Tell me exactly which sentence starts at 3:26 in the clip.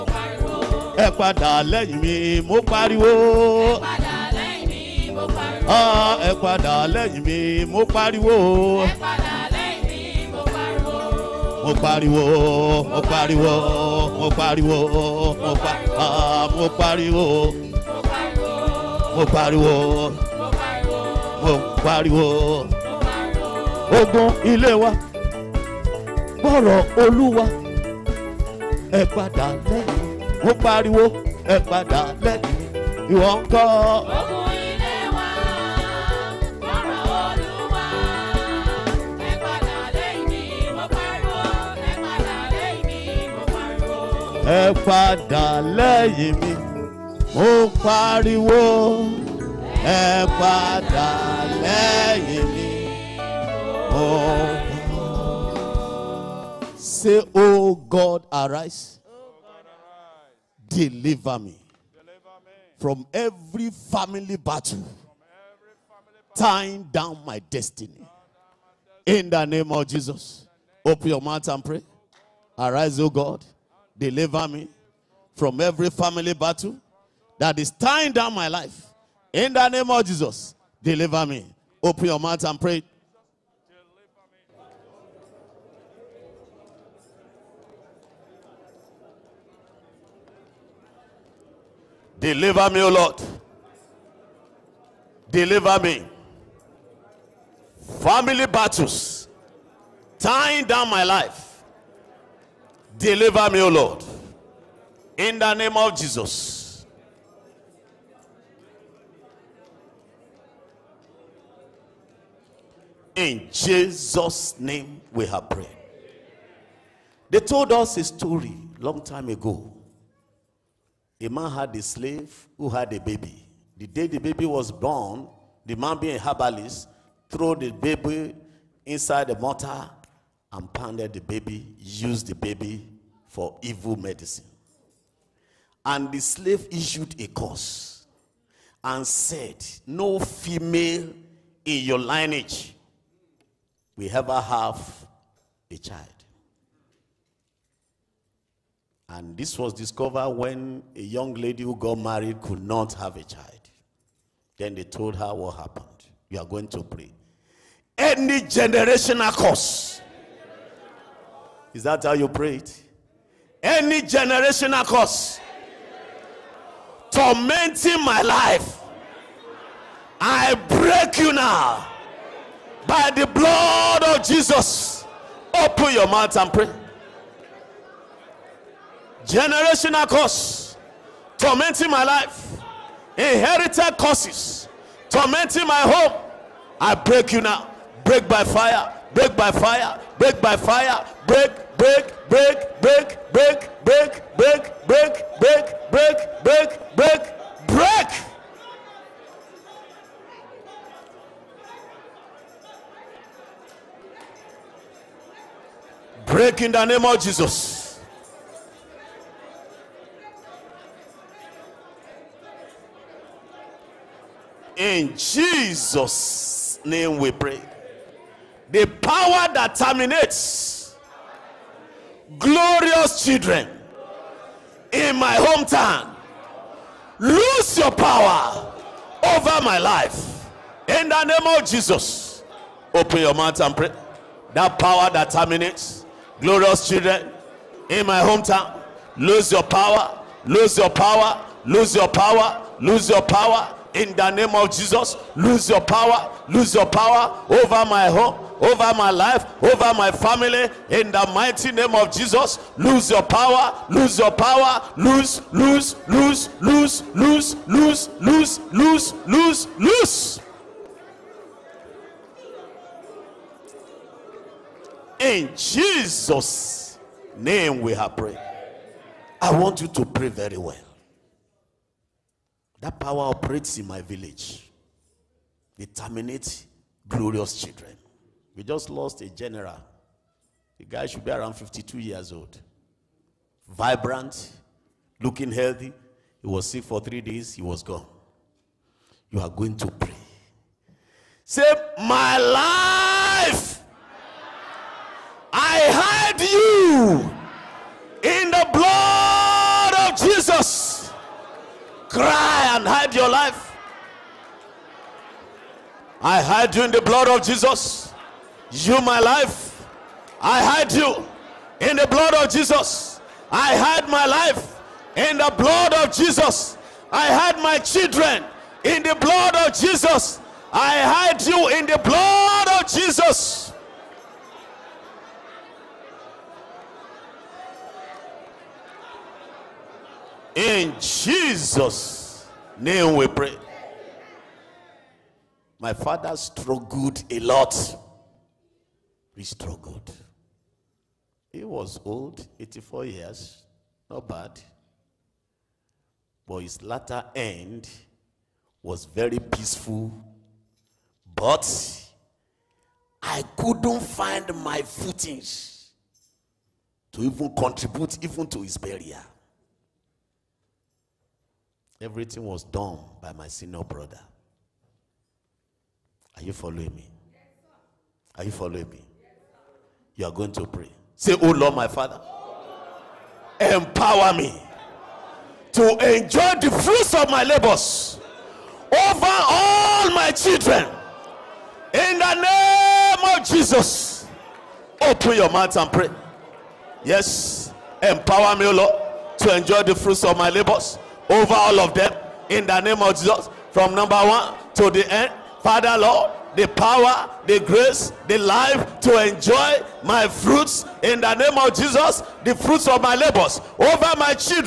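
Break in the name of Jesus.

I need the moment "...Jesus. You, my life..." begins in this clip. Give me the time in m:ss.
5:07.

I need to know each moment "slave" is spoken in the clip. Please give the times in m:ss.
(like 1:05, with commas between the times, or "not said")
2:01, 2:16.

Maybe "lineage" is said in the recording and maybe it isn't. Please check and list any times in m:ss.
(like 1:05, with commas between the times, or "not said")
2:21.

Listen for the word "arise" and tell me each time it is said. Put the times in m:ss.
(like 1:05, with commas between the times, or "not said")
0:58, 1:12.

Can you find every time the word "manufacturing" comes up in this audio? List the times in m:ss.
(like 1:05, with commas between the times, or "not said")
not said.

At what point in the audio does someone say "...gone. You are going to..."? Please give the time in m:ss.
4:47.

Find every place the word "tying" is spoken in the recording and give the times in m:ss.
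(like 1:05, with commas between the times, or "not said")
1:06, 1:17, 1:40.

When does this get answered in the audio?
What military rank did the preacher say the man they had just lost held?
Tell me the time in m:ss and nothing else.
4:39.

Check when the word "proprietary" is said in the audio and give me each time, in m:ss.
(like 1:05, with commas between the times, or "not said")
not said.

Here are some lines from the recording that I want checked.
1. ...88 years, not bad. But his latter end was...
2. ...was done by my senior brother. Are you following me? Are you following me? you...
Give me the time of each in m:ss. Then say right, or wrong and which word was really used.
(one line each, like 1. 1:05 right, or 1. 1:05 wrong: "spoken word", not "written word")
1. 5:42 wrong: "84", not "88"
2. 6:02 right.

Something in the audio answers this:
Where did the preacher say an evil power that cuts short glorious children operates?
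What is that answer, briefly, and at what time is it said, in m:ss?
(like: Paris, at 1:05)
In my village, at 4:33.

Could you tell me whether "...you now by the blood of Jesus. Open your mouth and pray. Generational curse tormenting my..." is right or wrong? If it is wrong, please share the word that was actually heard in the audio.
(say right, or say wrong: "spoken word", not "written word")
right.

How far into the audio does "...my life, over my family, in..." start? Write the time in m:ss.
4:08.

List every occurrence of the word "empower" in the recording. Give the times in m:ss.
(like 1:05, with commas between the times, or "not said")
6:13, 6:28.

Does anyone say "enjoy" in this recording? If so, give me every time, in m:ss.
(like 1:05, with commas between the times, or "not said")
6:16, 6:29, 6:39.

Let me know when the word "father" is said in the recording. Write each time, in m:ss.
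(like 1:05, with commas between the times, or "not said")
5:35, 6:11, 6:35.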